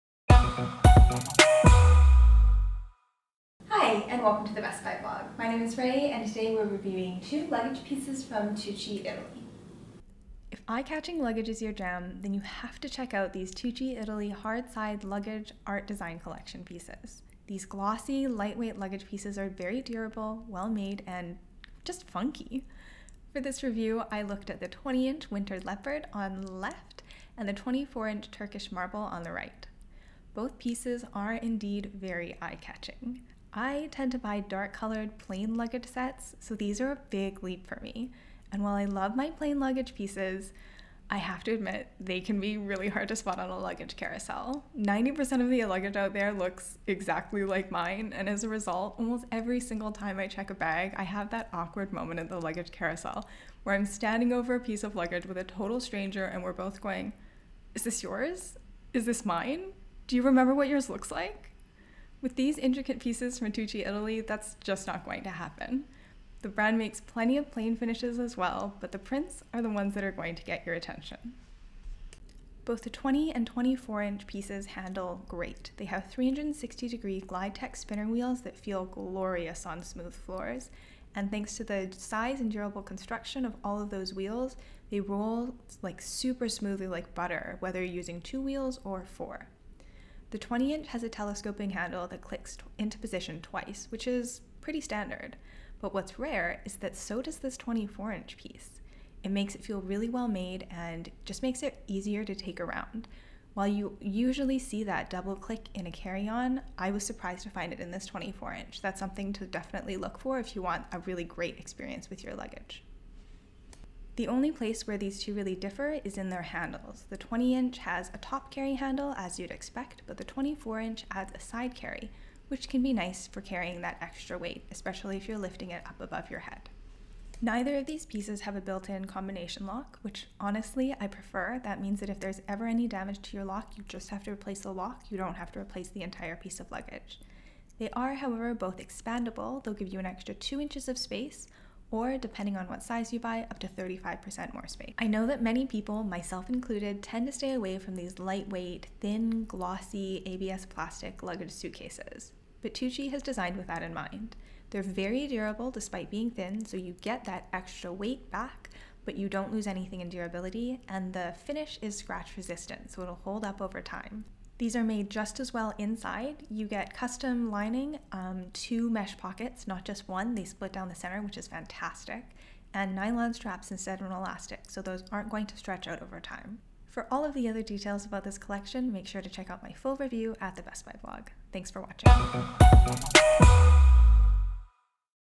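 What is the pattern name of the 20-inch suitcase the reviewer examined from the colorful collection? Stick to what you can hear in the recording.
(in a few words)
winter leopard.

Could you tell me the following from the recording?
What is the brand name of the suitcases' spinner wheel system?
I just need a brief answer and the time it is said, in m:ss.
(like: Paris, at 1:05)
Glidetech, at 1:17.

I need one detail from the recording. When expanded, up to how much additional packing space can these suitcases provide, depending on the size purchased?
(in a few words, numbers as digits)
35%.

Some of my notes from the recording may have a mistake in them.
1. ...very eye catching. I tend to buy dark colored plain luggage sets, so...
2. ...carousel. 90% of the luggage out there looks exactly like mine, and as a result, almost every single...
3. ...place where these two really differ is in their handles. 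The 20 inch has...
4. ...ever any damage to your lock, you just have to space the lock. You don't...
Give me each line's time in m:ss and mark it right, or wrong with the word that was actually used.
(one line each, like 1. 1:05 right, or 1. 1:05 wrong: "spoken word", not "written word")
1. 0:31 right
2. 0:43 right
3. 1:54 right
4. 2:12 wrong: "replace", not "space".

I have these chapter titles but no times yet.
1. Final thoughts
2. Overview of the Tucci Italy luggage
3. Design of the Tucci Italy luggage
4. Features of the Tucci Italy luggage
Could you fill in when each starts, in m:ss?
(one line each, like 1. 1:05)
1. 2:24
2. 0:10
3. 0:30
4. 1:12.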